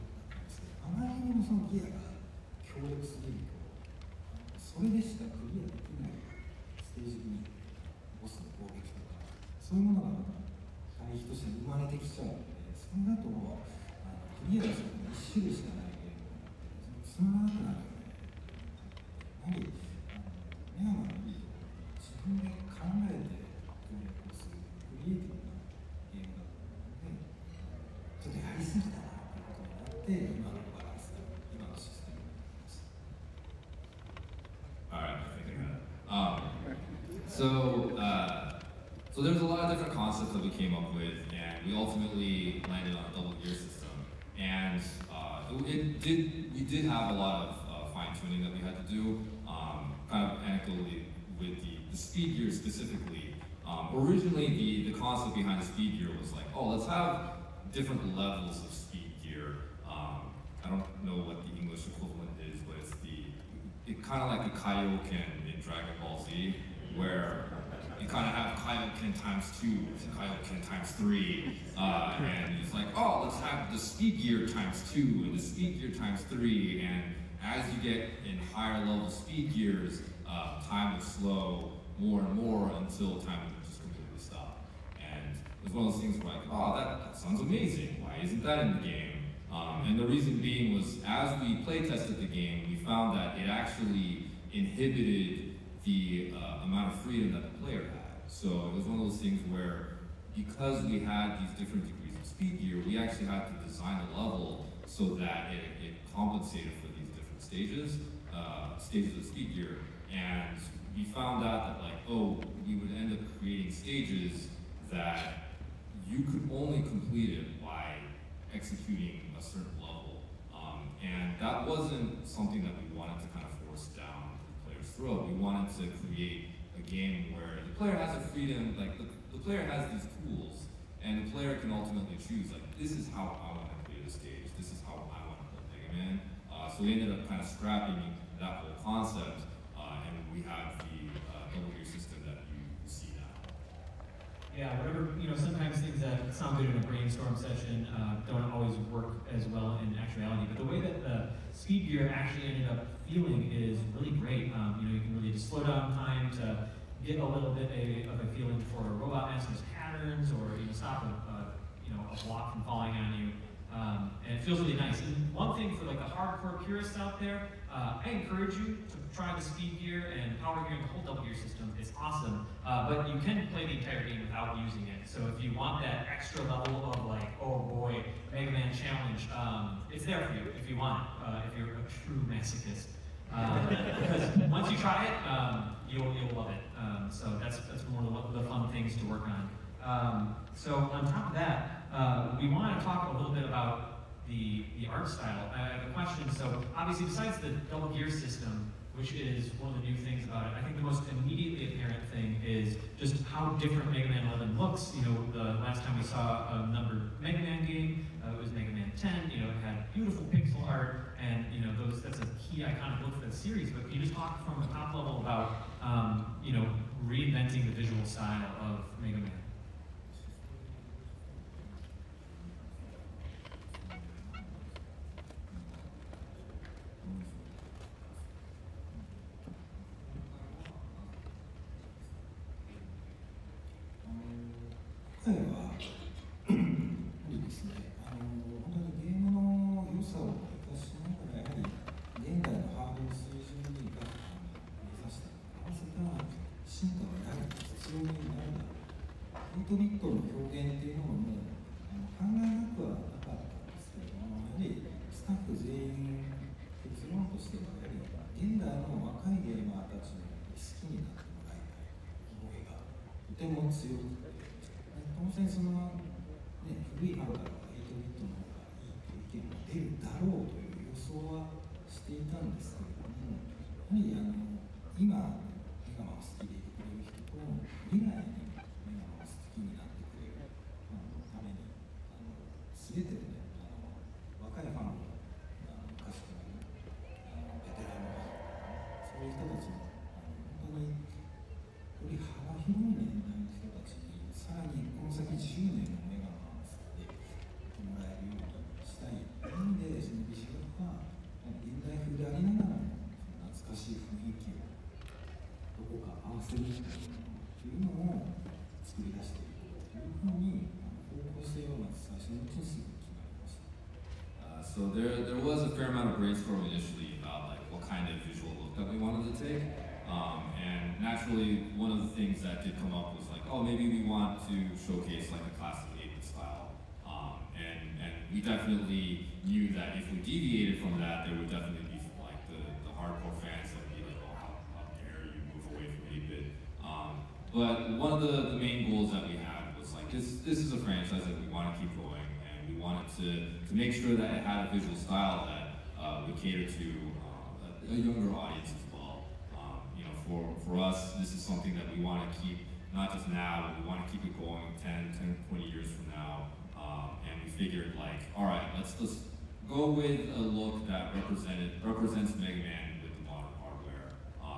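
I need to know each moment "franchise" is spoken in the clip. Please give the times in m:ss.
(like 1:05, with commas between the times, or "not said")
5:40.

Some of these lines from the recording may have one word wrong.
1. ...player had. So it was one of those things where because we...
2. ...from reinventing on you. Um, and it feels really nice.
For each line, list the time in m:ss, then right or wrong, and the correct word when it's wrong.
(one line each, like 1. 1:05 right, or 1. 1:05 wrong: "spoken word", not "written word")
1. 1:37 right
2. 2:42 wrong: "falling", not "reinventing".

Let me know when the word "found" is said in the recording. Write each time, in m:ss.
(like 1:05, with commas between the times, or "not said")
1:32, 1:51.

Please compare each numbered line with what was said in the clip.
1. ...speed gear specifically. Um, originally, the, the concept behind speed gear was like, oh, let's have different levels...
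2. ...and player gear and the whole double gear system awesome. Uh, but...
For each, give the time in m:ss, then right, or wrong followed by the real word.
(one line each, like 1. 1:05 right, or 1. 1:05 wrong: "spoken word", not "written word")
1. 0:51 right
2. 2:50 wrong: "power", not "player".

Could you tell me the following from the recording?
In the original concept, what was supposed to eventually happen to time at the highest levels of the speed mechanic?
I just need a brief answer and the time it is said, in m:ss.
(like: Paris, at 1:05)
completely stop, at 1:23.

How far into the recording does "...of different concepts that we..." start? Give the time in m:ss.
0:39.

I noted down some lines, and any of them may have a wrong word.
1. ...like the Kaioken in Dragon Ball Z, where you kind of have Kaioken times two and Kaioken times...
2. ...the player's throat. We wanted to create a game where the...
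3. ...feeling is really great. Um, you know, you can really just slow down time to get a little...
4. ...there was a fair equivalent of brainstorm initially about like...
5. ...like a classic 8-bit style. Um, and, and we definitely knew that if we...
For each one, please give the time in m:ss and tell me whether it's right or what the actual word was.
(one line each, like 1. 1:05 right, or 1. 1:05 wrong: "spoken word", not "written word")
1. 1:04 right
2. 2:04 right
3. 2:33 right
4. 5:15 wrong: "amount", not "equivalent"
5. 5:25 right.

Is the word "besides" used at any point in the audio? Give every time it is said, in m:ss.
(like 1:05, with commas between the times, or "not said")
3:17.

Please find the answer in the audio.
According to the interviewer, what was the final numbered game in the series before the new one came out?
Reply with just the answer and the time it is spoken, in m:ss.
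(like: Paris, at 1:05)
Mega Man 10, at 3:28.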